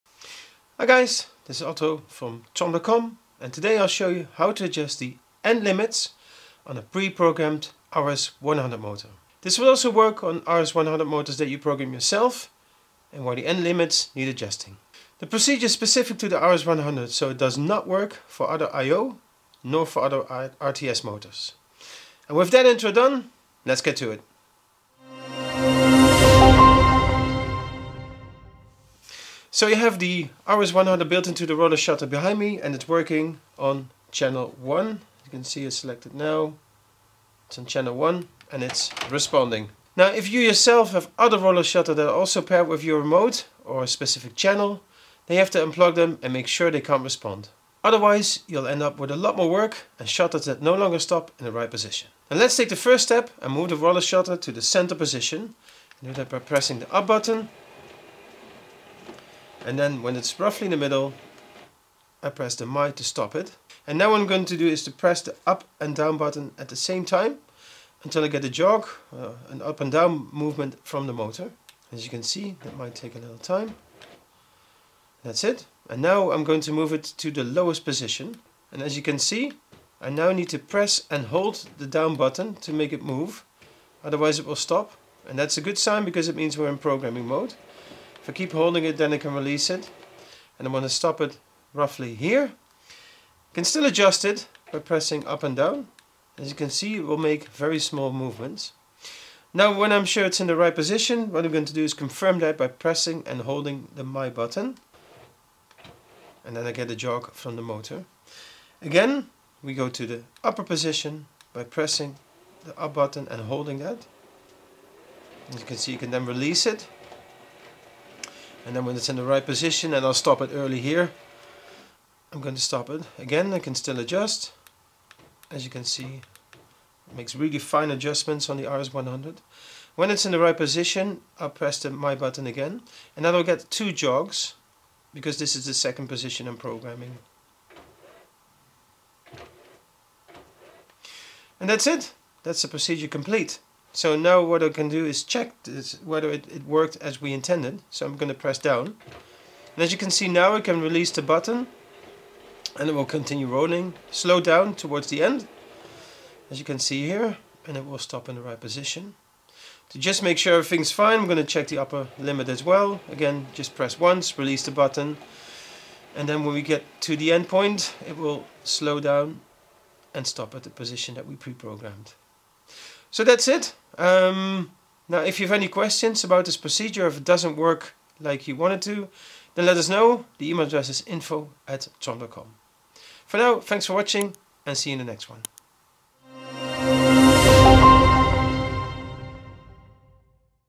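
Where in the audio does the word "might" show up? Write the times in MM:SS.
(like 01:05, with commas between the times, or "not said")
01:12.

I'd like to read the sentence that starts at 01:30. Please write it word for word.
And I'm going to stop it roughly here.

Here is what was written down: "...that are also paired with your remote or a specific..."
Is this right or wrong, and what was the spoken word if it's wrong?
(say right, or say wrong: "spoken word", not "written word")
right.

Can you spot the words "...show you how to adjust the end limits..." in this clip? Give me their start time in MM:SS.
00:03.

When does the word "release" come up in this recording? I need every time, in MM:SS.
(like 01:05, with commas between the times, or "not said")
01:29, 01:56, 02:30, 02:44.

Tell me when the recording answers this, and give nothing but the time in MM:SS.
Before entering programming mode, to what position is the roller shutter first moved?
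00:54.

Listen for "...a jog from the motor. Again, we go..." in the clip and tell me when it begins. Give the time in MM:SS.
01:46.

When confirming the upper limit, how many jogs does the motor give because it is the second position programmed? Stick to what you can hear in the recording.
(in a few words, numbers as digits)
2.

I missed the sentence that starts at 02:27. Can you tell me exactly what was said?
So I'm going to press down.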